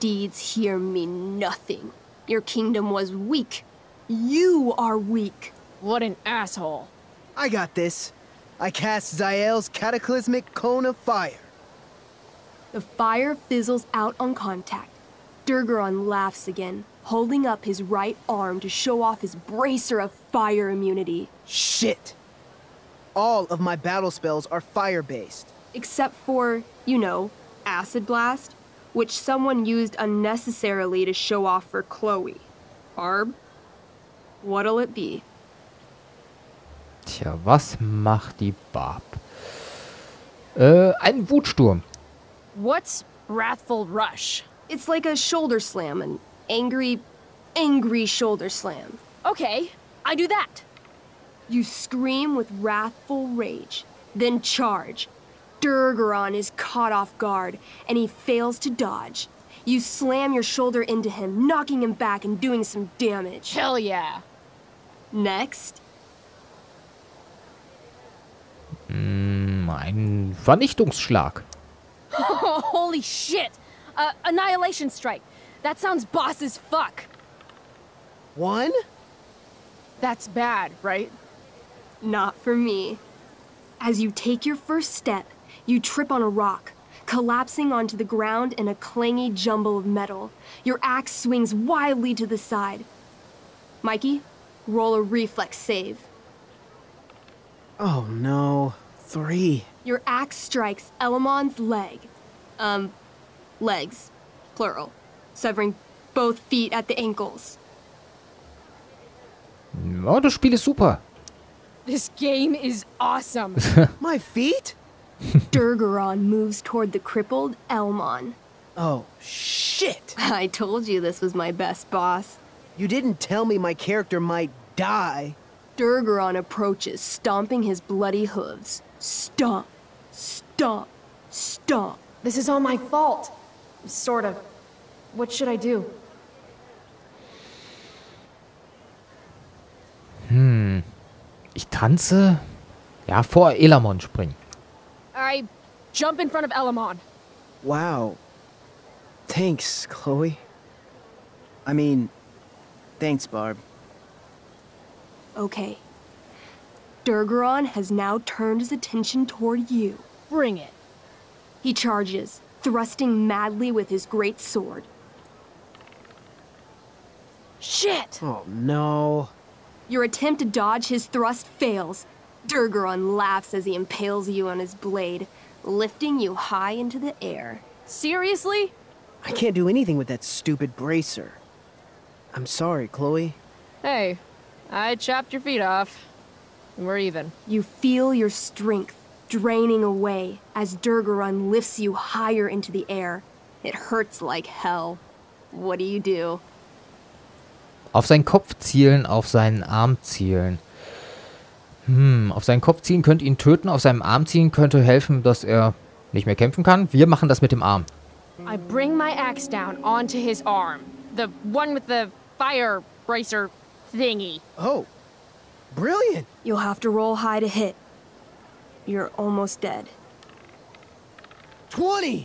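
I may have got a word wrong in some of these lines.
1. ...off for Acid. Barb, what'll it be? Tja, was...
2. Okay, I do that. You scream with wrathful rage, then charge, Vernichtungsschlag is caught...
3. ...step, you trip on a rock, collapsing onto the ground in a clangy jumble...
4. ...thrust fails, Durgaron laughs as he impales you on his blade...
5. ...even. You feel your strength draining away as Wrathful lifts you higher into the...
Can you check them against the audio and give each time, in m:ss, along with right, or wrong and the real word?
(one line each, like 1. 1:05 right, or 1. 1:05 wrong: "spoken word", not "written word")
1. 0:31 wrong: "Chloe", not "Acid"
2. 0:49 wrong: "Durgaron", not "Vernichtungsschlag"
3. 1:24 right
4. 2:51 right
5. 3:06 wrong: "Durgaron", not "Wrathful".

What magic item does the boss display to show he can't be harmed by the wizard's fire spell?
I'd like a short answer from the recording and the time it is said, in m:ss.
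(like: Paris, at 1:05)
Bracer of fire immunity, at 0:19.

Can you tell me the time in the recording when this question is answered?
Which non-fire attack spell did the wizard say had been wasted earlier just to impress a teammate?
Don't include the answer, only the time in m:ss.
0:27.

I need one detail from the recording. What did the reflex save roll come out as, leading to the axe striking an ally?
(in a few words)
3.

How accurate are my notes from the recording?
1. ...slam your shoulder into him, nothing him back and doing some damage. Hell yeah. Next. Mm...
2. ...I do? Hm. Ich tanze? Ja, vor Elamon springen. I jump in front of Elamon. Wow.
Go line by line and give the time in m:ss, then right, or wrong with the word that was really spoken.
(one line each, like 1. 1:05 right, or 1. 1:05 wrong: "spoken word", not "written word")
1. 0:59 wrong: "knocking", not "nothing"
2. 2:15 right.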